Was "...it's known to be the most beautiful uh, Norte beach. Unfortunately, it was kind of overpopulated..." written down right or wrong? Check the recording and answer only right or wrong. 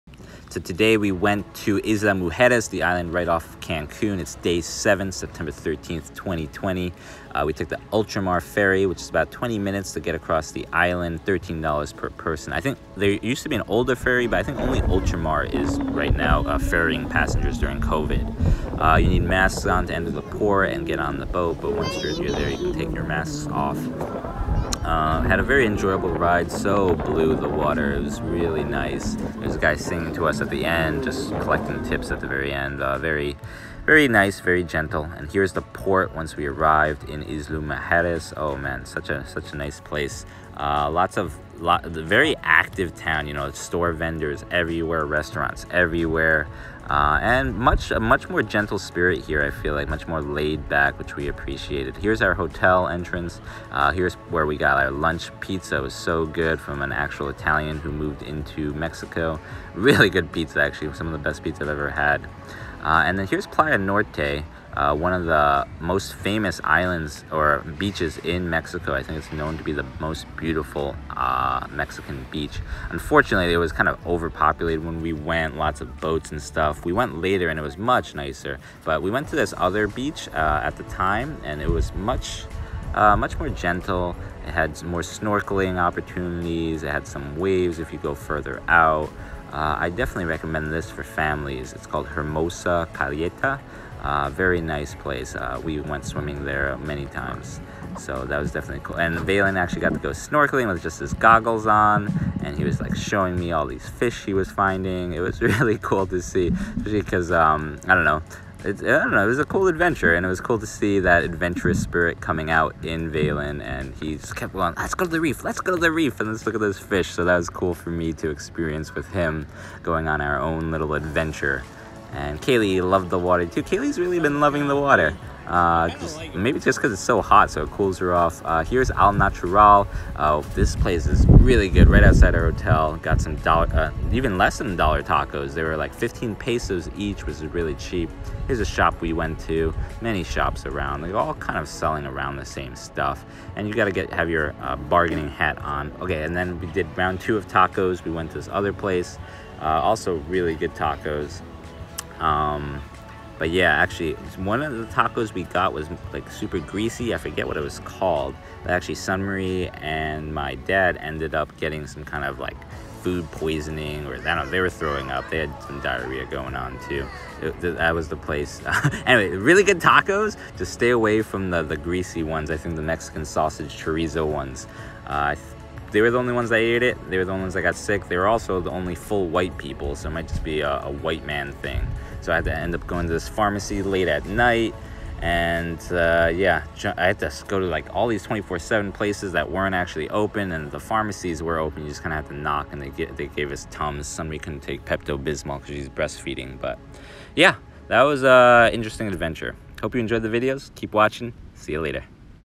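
wrong.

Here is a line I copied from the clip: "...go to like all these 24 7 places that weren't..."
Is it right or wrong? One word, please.
right.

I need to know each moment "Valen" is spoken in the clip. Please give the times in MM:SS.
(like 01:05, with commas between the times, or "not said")
01:39, 01:53.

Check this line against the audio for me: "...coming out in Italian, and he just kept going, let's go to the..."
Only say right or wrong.
wrong.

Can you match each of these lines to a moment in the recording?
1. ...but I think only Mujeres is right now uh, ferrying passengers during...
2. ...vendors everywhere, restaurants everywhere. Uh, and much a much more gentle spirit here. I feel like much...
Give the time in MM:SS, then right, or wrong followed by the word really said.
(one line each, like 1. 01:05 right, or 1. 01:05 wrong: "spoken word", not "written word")
1. 00:14 wrong: "Ultramar", not "Mujeres"
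2. 00:43 right.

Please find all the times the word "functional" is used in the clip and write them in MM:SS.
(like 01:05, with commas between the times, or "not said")
not said.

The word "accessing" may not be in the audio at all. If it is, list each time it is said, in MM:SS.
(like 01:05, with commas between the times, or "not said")
not said.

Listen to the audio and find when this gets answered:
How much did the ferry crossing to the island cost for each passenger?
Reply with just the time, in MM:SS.
00:11.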